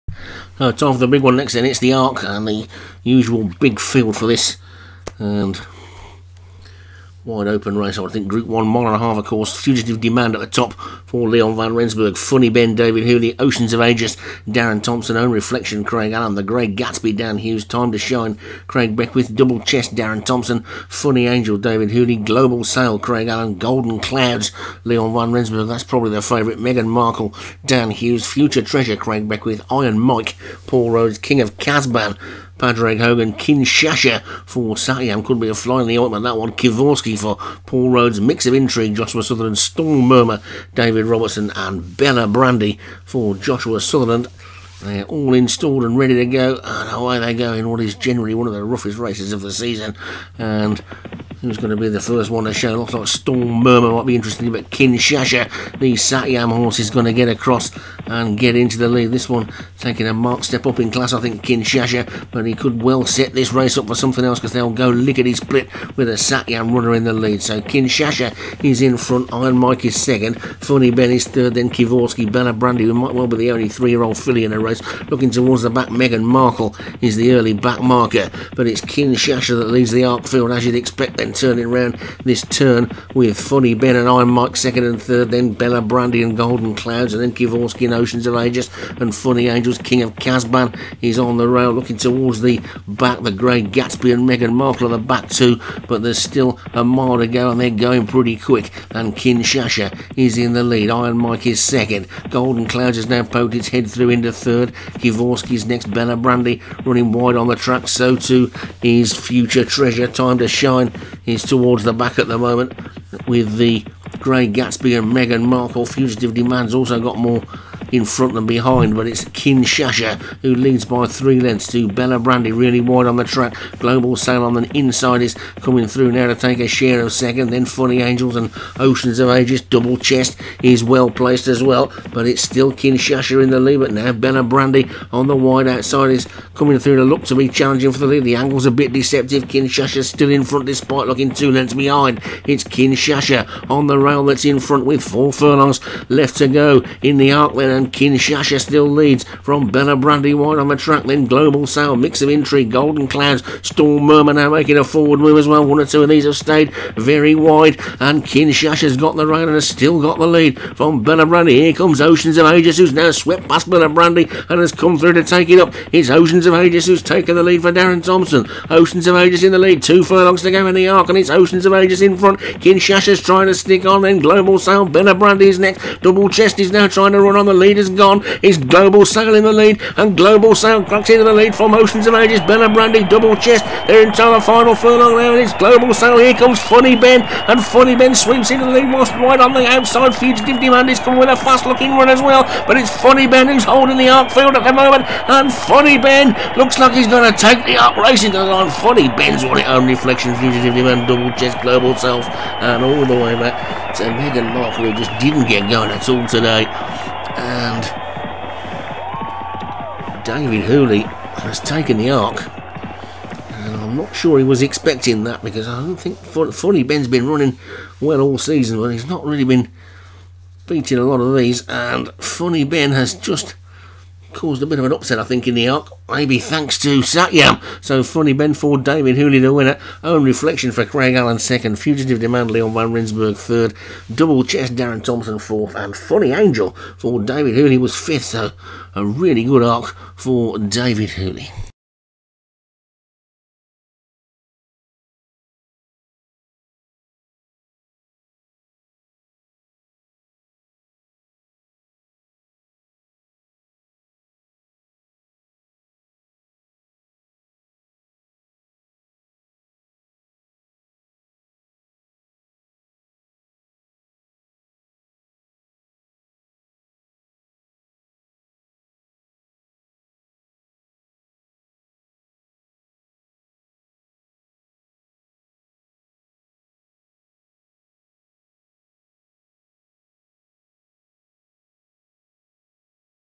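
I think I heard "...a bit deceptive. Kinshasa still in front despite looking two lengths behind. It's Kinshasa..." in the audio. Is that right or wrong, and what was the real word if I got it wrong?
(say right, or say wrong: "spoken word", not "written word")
right.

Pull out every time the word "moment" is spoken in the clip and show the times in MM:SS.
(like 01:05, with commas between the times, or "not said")
01:52, 03:14.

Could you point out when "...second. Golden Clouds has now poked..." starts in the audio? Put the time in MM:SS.
01:41.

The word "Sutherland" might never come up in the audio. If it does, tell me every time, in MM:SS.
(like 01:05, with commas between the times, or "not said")
00:39, 00:43.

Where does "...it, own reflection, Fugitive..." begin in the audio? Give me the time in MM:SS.
03:19.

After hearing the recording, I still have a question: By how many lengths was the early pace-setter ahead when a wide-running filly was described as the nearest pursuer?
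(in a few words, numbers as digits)
3.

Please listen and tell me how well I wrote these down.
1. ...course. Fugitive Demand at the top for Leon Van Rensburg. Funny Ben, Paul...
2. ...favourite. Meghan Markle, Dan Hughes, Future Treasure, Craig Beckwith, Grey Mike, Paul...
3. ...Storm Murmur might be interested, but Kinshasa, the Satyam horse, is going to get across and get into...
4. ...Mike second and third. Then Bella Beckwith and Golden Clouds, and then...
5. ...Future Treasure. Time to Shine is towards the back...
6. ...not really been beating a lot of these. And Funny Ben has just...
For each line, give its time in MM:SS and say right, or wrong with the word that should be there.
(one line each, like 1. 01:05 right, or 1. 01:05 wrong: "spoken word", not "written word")
1. 00:09 wrong: "David", not "Paul"
2. 00:26 wrong: "Iron", not "Grey"
3. 00:53 right
4. 01:24 wrong: "Brandy", not "Beckwith"
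5. 01:49 right
6. 03:39 right.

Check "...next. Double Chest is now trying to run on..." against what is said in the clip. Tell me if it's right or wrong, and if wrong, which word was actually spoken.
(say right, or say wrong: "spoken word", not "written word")
right.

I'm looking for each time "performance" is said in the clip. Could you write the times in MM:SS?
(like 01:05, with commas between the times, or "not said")
not said.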